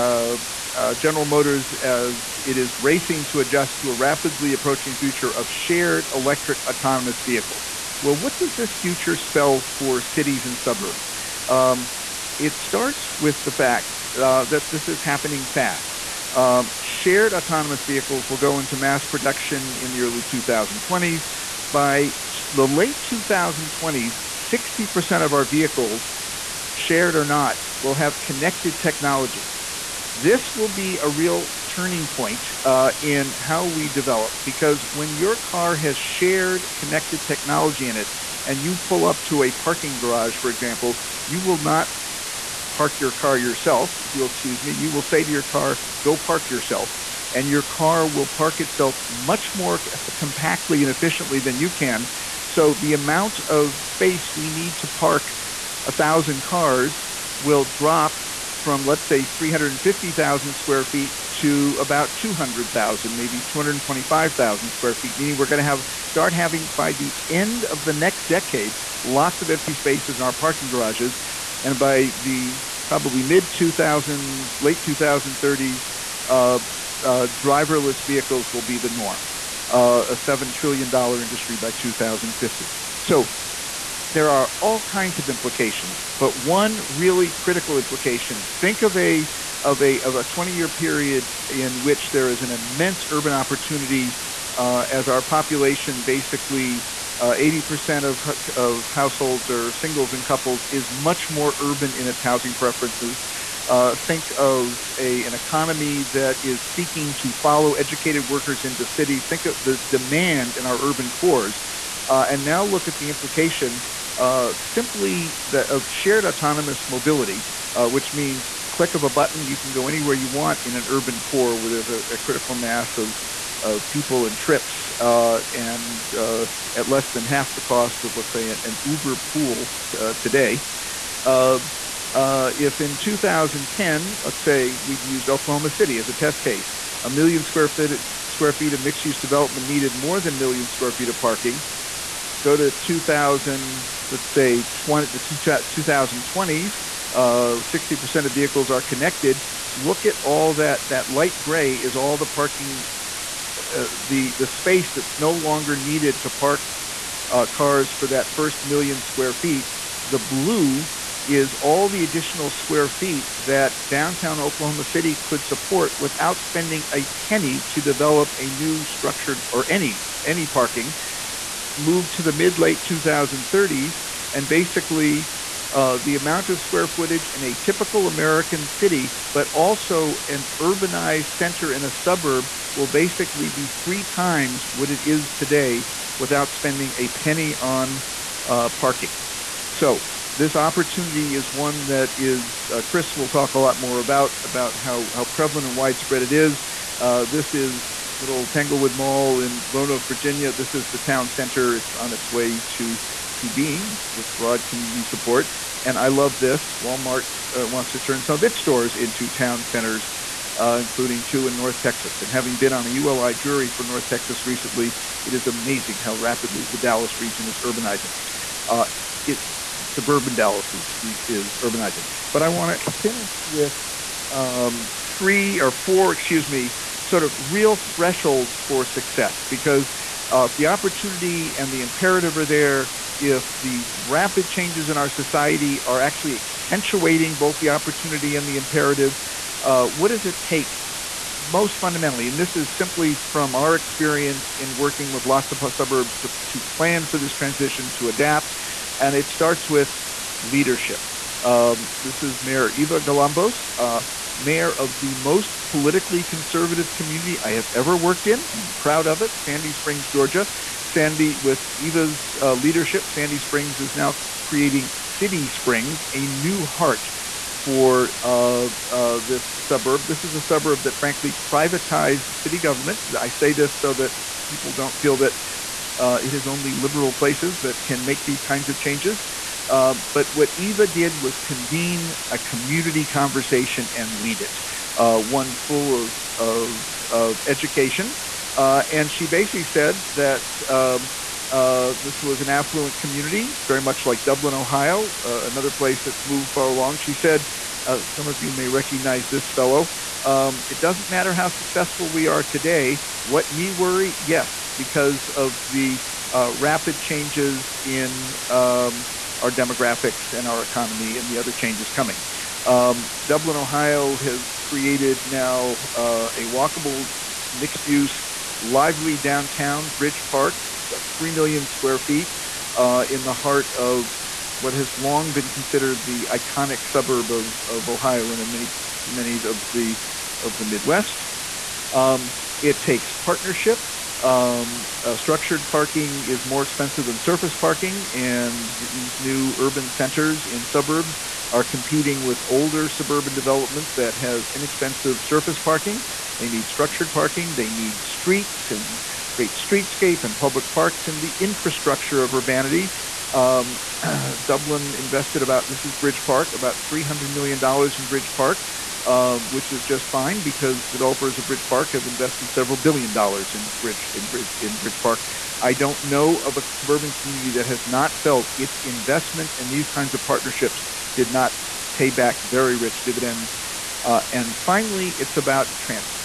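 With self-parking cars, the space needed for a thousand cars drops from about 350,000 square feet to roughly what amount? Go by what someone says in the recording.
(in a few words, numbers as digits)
200,000 square feet.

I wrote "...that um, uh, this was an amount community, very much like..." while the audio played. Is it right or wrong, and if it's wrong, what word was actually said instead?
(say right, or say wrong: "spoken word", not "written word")
wrong: "affluent", not "amount".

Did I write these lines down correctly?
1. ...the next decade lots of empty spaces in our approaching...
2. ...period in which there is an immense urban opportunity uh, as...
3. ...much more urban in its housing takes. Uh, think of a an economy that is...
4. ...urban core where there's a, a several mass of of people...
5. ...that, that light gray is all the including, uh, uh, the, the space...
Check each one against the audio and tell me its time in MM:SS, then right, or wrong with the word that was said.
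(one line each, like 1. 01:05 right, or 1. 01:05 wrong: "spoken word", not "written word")
1. 01:07 wrong: "parking", not "approaching"
2. 01:30 right
3. 01:40 wrong: "preferences", not "takes"
4. 02:00 wrong: "critical", not "several"
5. 02:30 wrong: "parking", not "including".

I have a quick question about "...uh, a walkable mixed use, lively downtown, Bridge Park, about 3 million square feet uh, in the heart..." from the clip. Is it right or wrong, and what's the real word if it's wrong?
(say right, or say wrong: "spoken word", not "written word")
right.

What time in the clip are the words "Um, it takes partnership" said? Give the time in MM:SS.
05:31.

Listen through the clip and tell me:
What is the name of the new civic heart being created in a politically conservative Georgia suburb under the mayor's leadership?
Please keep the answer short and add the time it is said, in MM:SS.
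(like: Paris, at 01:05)
City Springs, at 04:25.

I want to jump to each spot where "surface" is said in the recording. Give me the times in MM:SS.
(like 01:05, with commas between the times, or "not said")
05:37, 05:45.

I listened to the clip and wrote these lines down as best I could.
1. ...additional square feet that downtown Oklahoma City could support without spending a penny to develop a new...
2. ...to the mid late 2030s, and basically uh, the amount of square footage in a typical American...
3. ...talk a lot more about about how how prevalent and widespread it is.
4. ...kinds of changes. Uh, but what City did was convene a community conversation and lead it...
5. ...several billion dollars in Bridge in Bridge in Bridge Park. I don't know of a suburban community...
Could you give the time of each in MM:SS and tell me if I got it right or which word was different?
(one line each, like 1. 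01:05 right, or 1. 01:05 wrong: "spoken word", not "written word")
1. 02:42 right
2. 02:52 right
3. 03:13 right
4. 04:38 wrong: "Eva", not "City"
5. 06:02 right.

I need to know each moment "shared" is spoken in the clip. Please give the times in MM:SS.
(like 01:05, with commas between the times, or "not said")
00:05, 00:17, 00:26, 00:36, 01:56.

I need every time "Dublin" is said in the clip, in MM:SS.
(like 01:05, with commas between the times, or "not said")
04:54, 05:13, 05:54.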